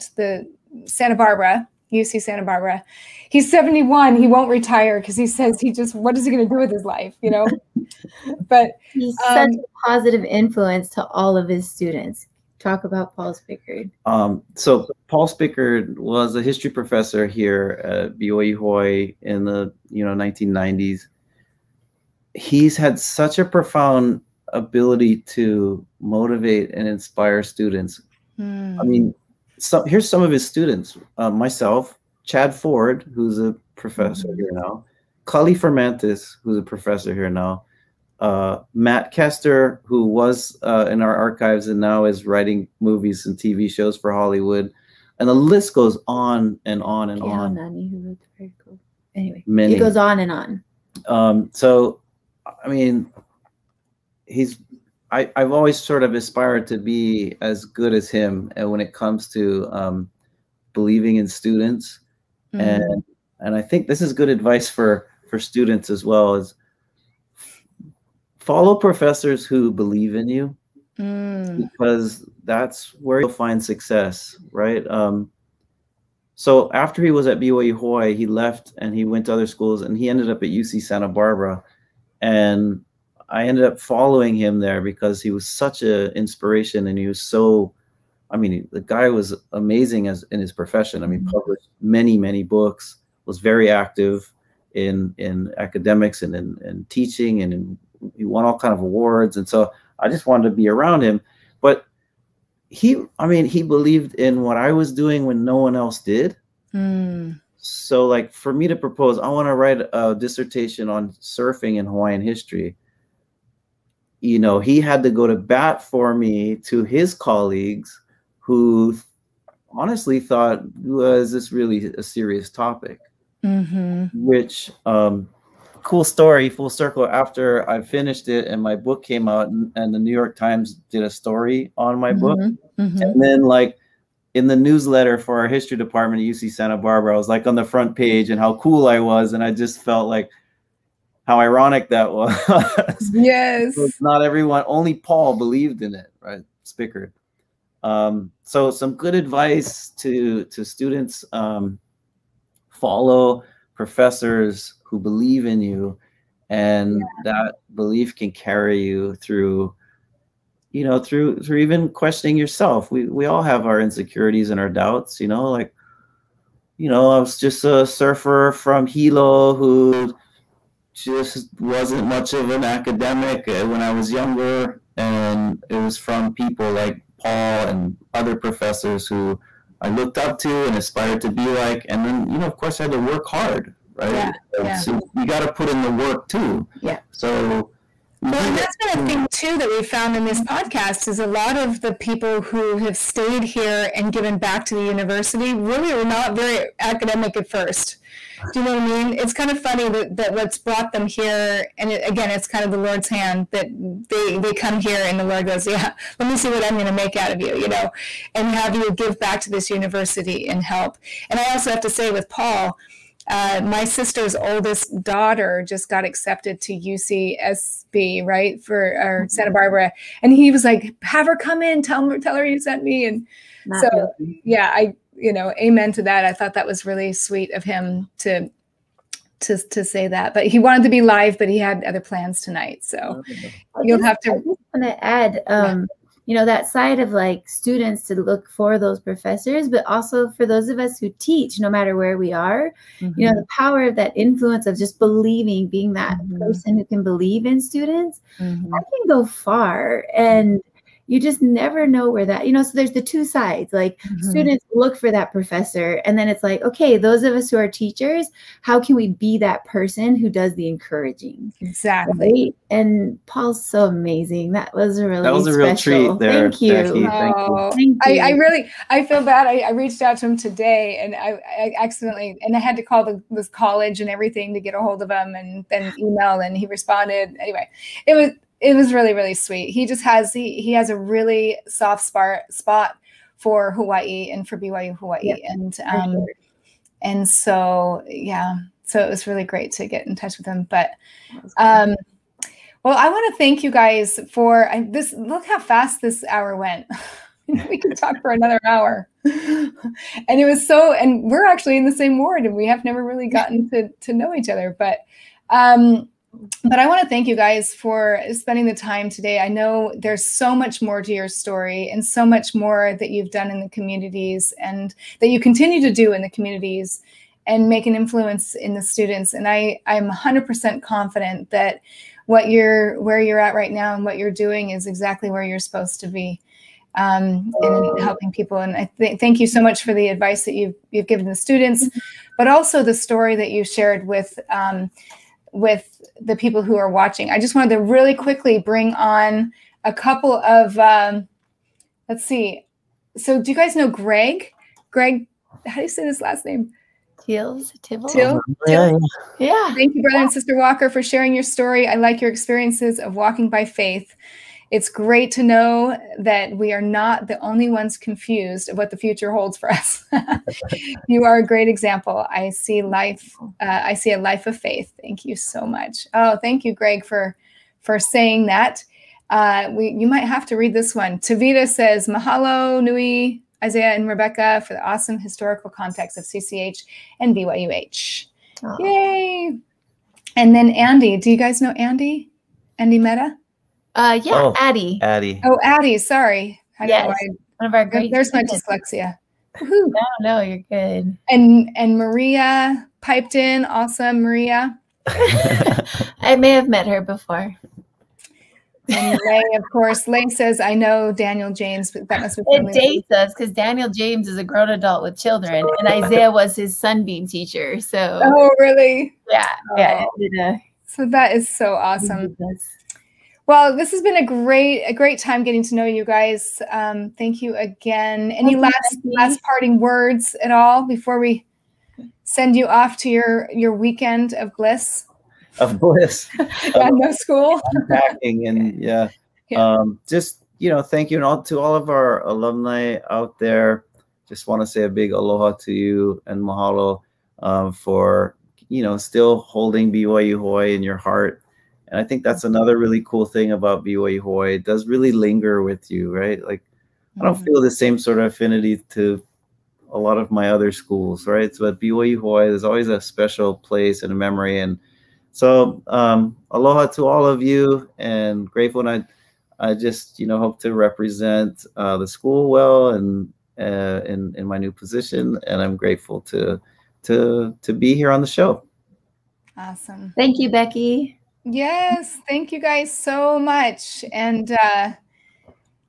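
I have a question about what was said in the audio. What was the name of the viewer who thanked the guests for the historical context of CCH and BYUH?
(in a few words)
Tavita.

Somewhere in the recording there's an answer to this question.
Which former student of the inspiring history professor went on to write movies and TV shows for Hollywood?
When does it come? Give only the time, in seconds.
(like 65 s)
38 s.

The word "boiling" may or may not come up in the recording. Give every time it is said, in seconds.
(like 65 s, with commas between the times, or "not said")
not said.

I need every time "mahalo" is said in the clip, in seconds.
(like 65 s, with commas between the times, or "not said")
372 s, 436 s.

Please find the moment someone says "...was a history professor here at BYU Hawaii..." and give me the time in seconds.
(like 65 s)
15 s.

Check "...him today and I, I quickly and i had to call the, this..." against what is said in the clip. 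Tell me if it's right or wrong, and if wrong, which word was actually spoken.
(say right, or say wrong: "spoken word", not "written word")
wrong: "accidentally", not "quickly".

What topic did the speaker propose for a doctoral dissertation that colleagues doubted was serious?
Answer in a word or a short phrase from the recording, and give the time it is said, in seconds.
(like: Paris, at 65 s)
surfing in Hawaiian history, at 111 s.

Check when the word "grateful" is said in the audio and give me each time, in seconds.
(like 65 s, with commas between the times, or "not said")
458 s, 465 s.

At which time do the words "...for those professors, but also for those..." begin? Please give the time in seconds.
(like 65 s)
238 s.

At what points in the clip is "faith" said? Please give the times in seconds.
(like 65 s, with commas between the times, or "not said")
353 s, 364 s.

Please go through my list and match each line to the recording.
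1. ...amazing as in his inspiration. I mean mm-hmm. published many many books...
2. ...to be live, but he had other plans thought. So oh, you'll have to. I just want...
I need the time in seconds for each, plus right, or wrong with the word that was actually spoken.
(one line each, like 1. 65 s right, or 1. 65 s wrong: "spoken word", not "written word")
1. 89 s wrong: "profession", not "inspiration"
2. 230 s wrong: "tonight", not "thought".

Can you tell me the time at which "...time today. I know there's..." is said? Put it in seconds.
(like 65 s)
308 s.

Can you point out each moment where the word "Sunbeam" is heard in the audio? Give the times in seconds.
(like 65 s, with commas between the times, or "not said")
406 s.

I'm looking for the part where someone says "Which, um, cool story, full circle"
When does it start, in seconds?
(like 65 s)
124 s.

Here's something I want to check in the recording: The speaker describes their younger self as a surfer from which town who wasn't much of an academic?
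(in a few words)
Hilo.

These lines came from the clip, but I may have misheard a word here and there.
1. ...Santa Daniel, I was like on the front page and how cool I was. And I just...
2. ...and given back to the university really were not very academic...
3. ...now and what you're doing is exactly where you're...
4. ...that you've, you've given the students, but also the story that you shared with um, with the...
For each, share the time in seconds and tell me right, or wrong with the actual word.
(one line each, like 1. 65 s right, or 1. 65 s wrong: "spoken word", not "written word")
1. 136 s wrong: "Barbara", not "Daniel"
2. 193 s right
3. 323 s right
4. 330 s right.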